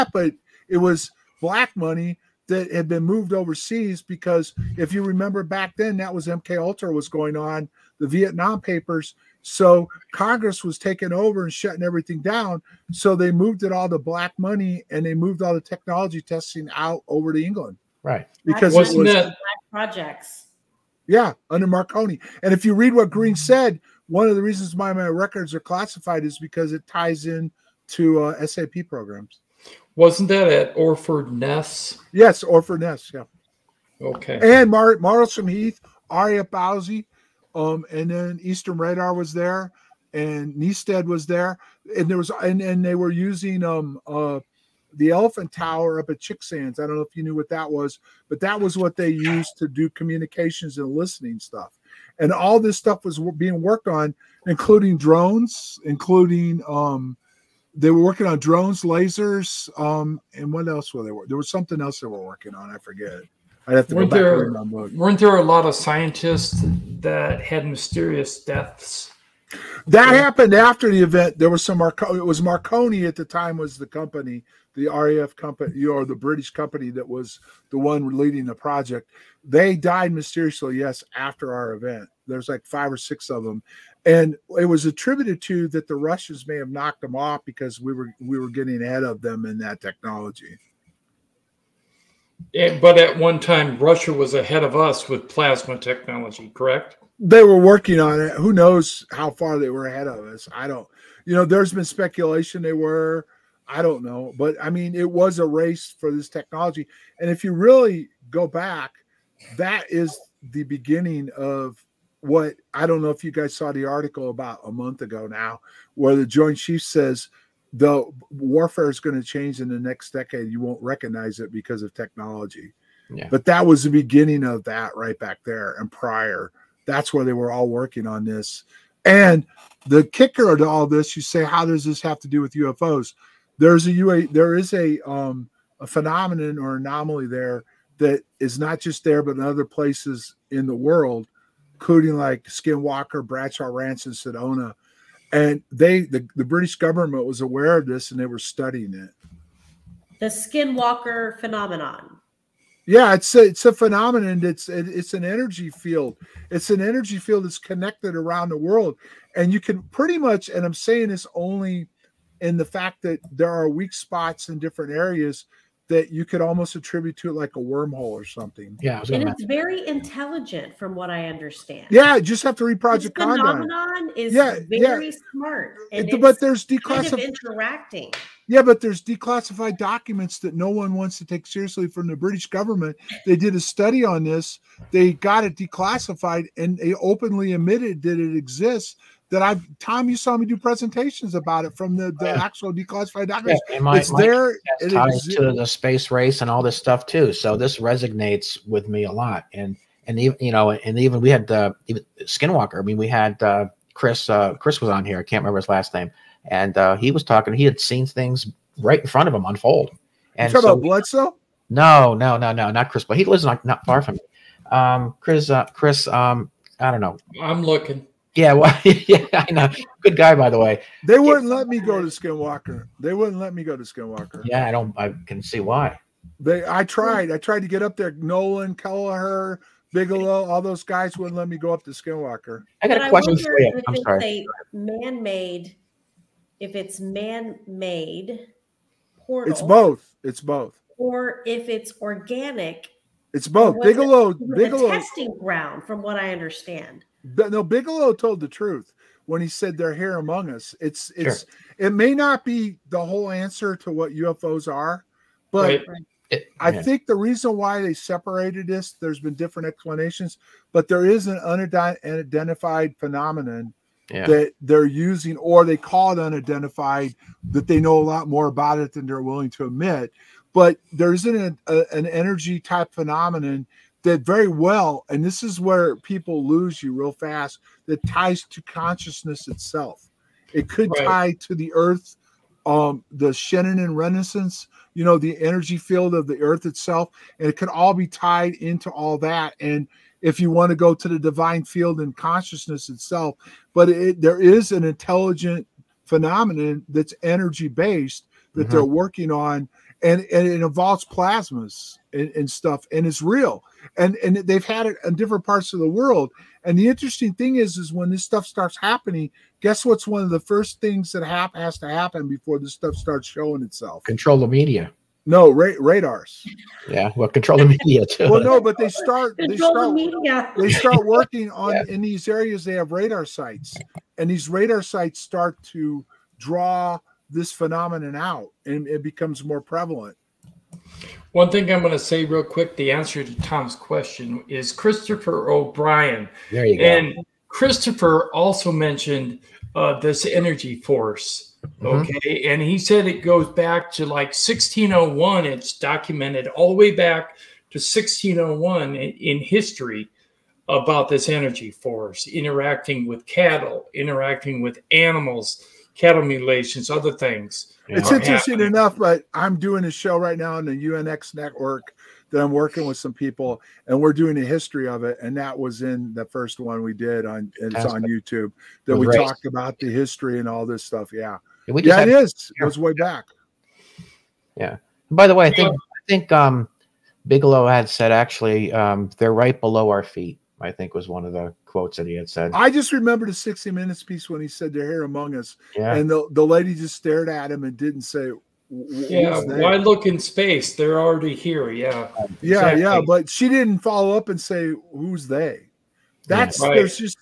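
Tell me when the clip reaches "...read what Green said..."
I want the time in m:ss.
0:22.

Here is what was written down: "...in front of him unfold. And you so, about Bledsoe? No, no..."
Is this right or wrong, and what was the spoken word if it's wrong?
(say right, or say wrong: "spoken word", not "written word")
right.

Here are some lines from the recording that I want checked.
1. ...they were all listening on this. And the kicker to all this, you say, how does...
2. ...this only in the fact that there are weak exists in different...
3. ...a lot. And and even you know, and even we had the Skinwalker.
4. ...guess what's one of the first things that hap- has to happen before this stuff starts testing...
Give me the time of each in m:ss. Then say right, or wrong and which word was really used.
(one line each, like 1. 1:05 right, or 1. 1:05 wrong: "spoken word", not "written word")
1. 2:07 wrong: "working", not "listening"
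2. 2:41 wrong: "spots", not "exists"
3. 3:19 right
4. 5:09 wrong: "showing", not "testing".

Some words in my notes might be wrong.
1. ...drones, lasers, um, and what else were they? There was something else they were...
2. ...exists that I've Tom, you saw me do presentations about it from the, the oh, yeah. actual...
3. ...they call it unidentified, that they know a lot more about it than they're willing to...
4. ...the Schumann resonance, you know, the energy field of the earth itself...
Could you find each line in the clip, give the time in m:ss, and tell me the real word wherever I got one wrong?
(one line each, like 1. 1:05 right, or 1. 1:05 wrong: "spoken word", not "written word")
1. 0:58 right
2. 3:08 right
3. 4:25 right
4. 4:43 right.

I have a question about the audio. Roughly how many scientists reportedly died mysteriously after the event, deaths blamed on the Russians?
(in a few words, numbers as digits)
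5 or 6.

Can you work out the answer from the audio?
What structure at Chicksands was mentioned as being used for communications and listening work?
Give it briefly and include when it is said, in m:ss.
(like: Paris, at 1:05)
Elephant Tower, at 0:45.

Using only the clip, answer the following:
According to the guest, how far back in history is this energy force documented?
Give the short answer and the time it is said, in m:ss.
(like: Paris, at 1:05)
1601, at 5:45.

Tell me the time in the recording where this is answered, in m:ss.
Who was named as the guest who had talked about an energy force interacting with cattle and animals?
5:34.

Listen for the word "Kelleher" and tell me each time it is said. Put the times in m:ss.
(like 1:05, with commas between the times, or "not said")
3:48.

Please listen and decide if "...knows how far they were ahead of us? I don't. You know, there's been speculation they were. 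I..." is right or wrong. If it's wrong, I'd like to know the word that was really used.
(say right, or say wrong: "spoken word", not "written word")
right.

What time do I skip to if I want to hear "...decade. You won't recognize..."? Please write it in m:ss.
2:00.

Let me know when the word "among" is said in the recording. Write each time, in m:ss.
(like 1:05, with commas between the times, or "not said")
4:10, 6:25.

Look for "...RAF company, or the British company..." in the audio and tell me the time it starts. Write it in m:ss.
1:14.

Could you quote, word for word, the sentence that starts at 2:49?
very intelligent, from what I understand.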